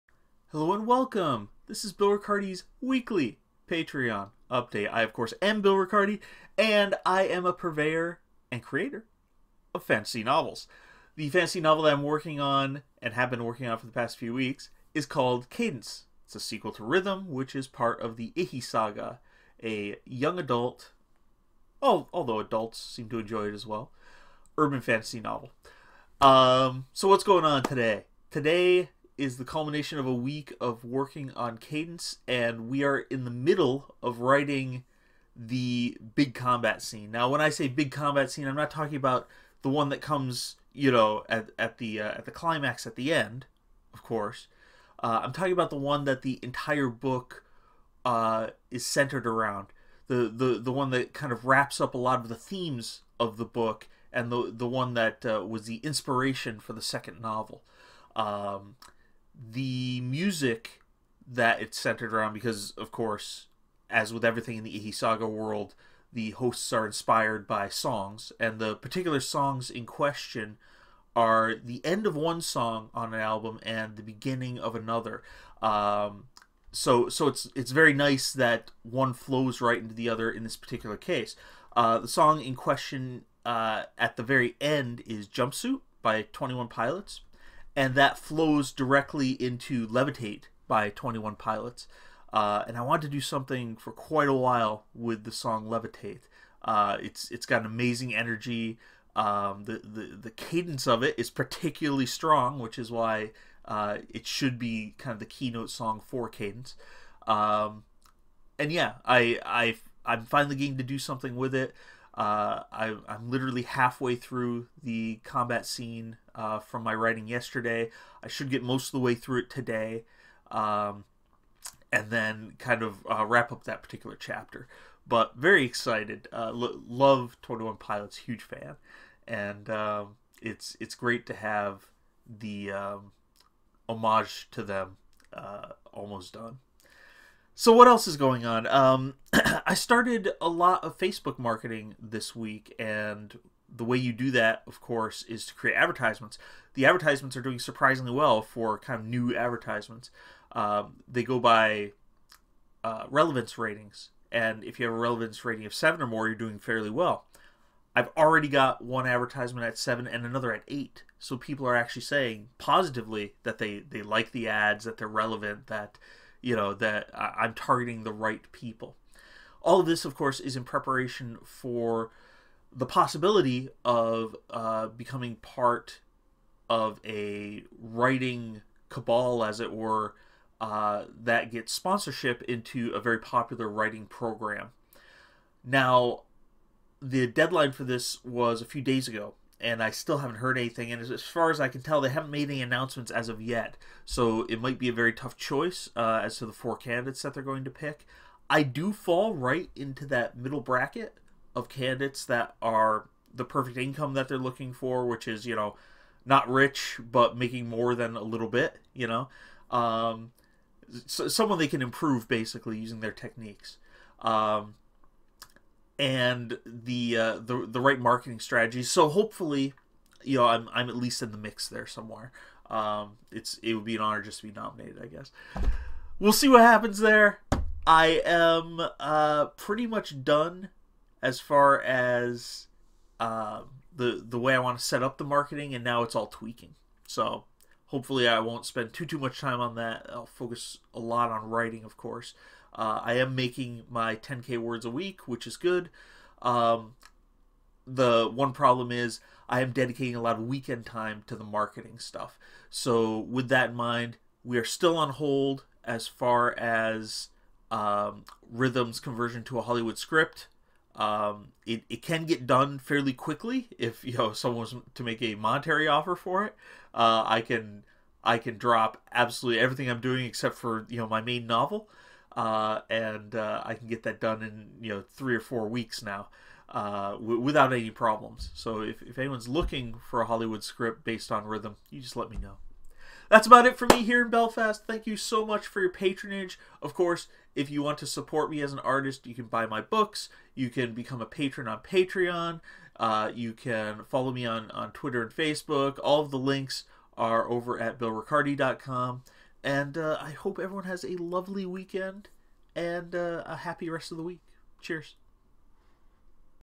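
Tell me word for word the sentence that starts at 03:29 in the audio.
Um, so someone they can improve basically using their techniques.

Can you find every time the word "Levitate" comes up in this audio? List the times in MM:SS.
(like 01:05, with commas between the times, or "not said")
01:29, 01:35.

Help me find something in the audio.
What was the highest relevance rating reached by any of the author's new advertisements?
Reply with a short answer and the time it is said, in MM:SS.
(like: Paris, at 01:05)
8, at 02:40.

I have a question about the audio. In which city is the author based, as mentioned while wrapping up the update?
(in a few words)
Belfast.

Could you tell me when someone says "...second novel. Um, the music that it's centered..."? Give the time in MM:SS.
00:56.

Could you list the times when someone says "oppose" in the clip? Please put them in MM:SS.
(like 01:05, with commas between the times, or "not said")
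not said.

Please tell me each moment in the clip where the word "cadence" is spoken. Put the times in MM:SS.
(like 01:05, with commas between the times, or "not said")
00:15, 00:31, 01:40, 01:46.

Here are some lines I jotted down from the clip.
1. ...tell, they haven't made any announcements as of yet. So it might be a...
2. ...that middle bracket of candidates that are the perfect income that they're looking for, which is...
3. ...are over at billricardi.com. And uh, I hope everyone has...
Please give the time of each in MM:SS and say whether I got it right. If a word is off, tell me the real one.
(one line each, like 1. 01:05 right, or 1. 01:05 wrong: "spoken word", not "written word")
1. 03:11 right
2. 03:20 right
3. 04:57 right.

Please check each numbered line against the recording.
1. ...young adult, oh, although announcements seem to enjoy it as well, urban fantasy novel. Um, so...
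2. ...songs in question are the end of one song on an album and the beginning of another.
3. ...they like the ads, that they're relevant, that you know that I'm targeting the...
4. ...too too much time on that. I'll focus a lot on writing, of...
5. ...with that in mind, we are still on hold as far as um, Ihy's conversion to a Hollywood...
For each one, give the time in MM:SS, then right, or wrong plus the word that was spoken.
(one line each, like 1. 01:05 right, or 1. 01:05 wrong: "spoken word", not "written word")
1. 00:20 wrong: "adults", not "announcements"
2. 01:09 right
3. 02:43 right
4. 03:58 right
5. 04:13 wrong: "Rhythm", not "Ihy".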